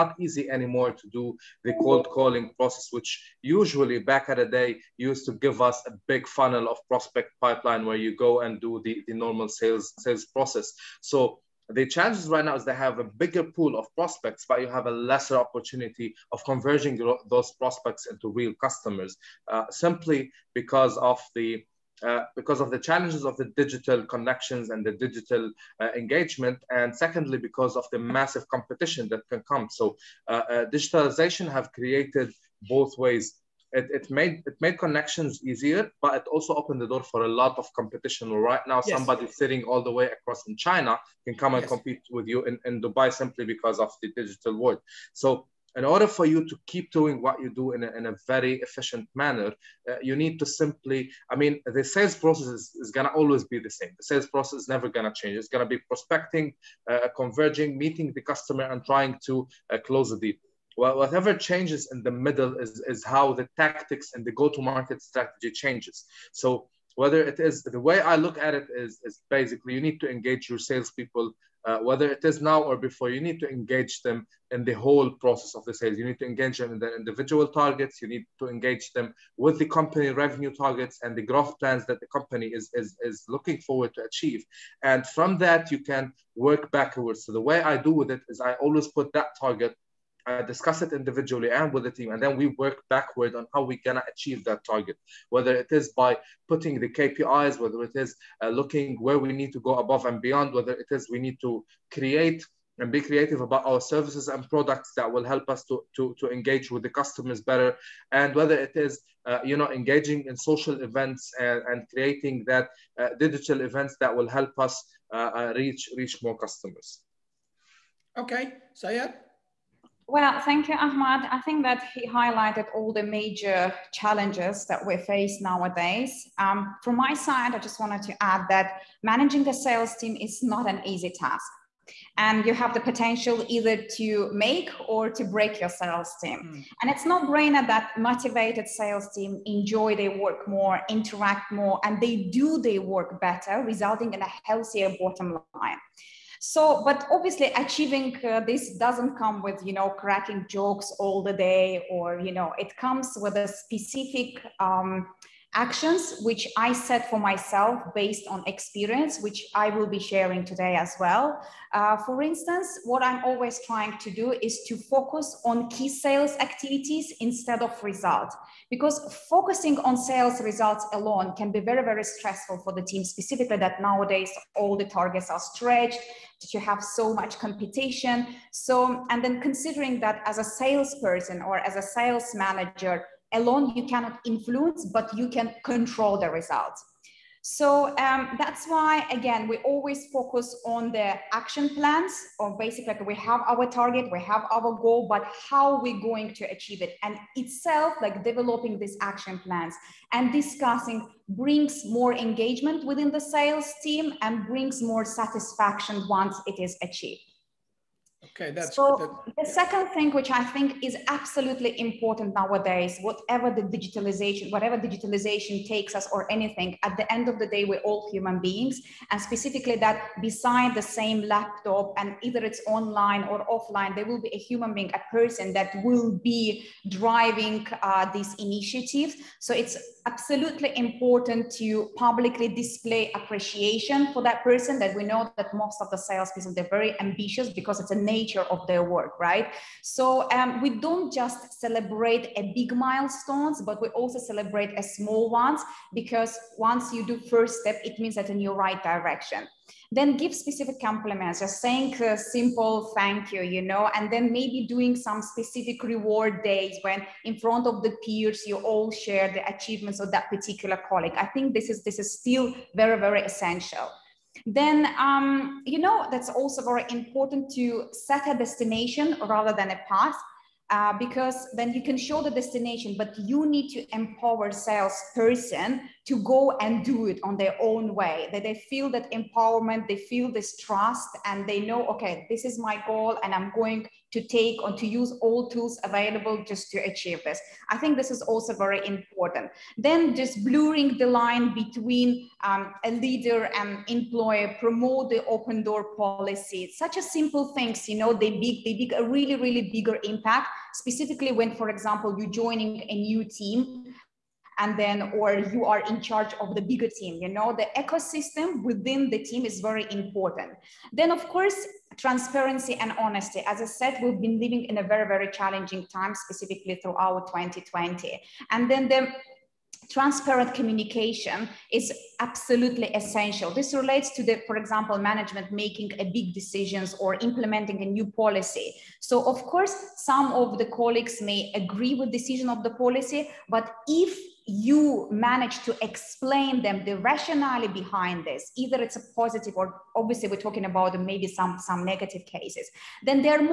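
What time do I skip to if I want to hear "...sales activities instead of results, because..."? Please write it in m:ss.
2:45.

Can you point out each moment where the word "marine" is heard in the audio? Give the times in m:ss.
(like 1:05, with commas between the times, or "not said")
not said.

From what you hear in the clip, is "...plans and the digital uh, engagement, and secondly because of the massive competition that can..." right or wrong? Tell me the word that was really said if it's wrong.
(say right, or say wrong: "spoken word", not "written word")
wrong: "connections", not "plans".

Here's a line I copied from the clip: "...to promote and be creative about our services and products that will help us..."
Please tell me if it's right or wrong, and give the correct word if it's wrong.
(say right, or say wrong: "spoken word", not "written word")
wrong: "create", not "promote".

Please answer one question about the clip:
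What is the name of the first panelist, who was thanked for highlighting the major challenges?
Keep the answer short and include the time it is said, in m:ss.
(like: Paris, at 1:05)
Ahmad, at 2:00.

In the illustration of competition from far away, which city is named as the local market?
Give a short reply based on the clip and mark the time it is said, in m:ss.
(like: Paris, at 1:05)
Dubai, at 0:42.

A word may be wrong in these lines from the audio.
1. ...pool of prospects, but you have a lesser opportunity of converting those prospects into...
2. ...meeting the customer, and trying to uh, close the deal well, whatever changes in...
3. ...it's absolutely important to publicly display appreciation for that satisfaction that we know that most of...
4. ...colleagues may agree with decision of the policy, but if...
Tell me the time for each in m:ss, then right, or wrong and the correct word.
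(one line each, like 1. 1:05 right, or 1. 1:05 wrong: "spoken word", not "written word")
1. 0:13 right
2. 0:57 right
3. 3:49 wrong: "person", not "satisfaction"
4. 5:30 right.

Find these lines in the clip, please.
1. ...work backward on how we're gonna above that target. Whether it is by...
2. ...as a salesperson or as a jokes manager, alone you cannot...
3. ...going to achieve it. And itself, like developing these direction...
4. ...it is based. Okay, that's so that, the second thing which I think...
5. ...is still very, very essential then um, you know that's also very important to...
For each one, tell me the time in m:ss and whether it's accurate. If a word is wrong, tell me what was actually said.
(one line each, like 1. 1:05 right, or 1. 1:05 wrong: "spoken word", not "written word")
1. 1:32 wrong: "achieve", not "above"
2. 3:00 wrong: "sales", not "jokes"
3. 3:16 wrong: "action", not "direction"
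4. 3:26 wrong: "achieved", not "based"
5. 4:21 right.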